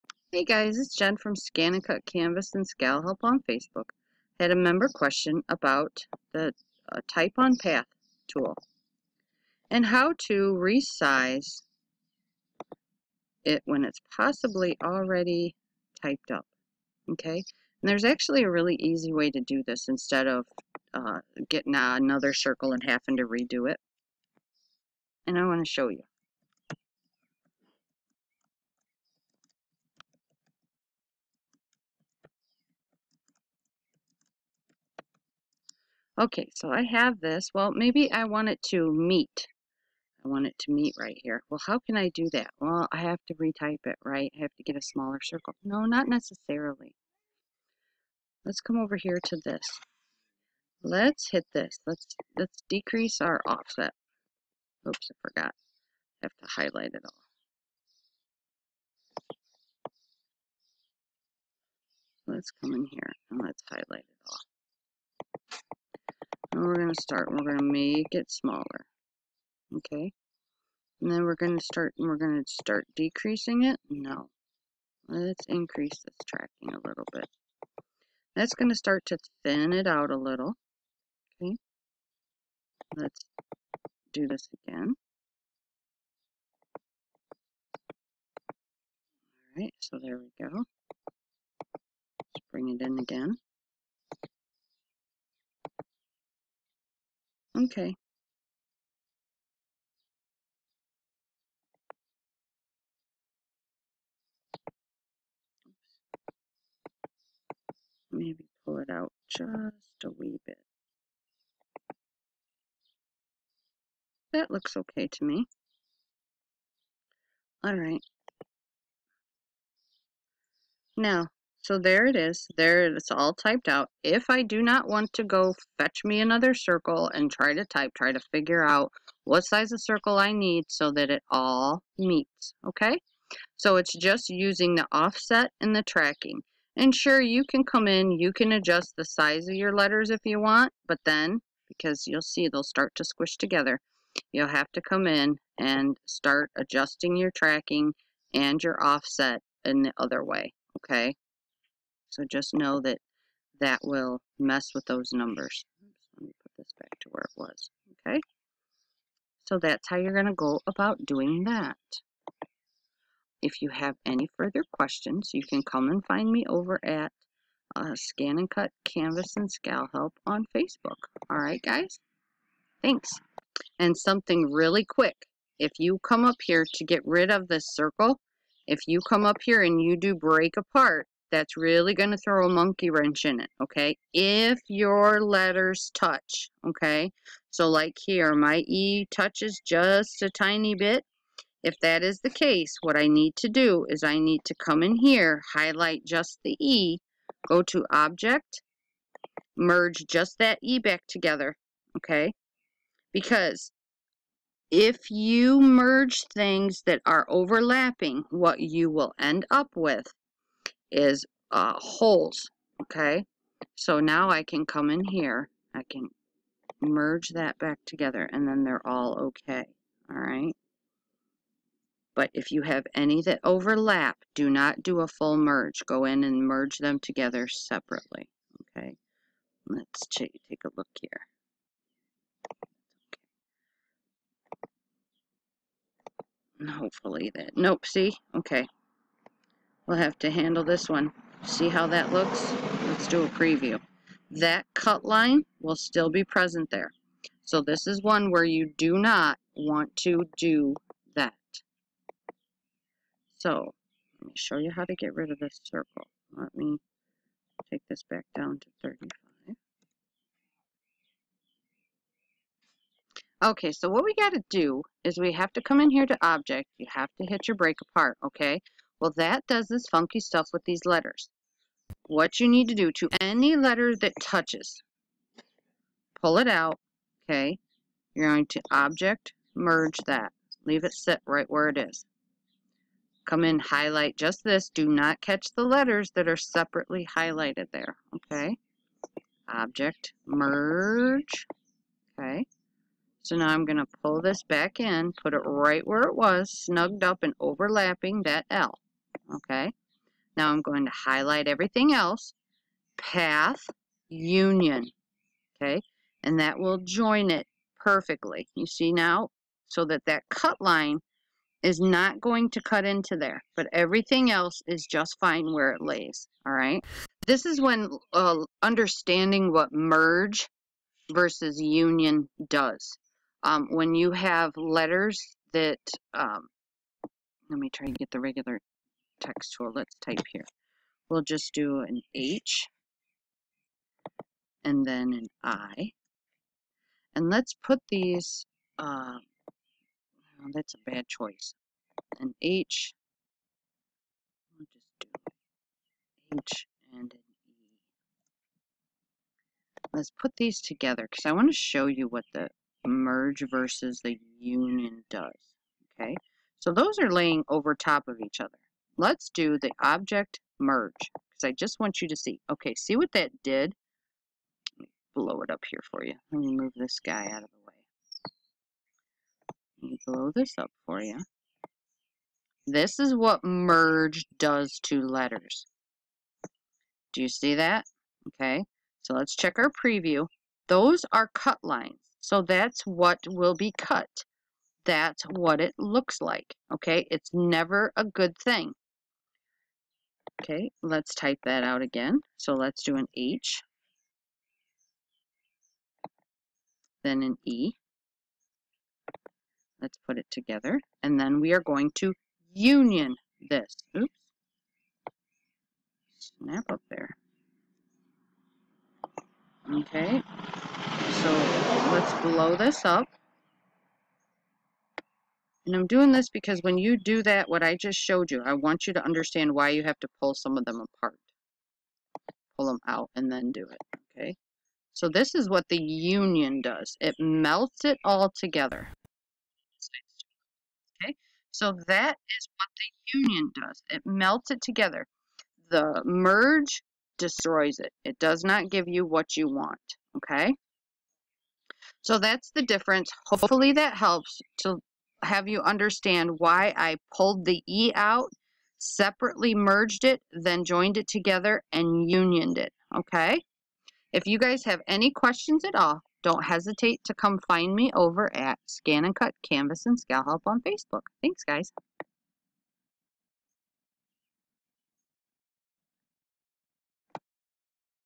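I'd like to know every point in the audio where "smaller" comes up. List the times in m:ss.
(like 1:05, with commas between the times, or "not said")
0:44, 1:08.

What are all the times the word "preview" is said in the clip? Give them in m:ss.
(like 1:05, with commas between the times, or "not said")
4:03, 6:19.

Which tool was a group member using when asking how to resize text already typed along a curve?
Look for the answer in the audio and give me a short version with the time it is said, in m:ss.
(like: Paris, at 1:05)
Type on Path, at 0:07.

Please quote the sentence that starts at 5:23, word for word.
Um, when you have letters that, um, let me try to get the regular text tool.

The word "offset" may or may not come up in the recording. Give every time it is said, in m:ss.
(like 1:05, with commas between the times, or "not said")
0:53, 2:14, 2:28.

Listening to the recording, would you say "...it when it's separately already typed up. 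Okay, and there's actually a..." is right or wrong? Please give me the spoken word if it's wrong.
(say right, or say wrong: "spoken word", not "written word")
wrong: "possibly", not "separately".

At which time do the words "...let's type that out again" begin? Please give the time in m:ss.
6:30.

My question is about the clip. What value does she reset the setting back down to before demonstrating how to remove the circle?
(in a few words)
35.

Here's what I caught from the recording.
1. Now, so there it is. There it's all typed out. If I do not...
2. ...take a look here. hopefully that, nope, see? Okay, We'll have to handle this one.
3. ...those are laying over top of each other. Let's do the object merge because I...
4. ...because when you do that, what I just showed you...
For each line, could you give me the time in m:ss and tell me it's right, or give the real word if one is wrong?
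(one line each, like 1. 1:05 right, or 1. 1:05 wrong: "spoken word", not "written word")
1. 2:00 right
2. 3:50 right
3. 5:56 right
4. 6:56 right.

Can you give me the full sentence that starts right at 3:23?
Because if you merge things that are overlapping, what you will end up with is uh, holes, okay?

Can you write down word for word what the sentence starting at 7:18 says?
It does not give you what you want, okay?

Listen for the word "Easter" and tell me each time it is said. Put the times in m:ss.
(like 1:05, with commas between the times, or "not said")
not said.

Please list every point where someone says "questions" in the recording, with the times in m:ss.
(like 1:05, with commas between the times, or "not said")
0:04, 2:44, 7:35.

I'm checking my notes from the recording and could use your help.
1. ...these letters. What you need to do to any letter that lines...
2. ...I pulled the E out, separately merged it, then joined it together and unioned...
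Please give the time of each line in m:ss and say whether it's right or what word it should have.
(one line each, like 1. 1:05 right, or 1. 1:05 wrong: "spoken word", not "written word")
1. 4:30 wrong: "touches", not "lines"
2. 7:26 right.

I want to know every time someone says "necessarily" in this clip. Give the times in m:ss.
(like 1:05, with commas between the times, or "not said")
0:46.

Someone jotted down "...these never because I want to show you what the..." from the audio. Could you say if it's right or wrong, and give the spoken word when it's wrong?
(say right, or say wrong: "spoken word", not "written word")
wrong: "together", not "never".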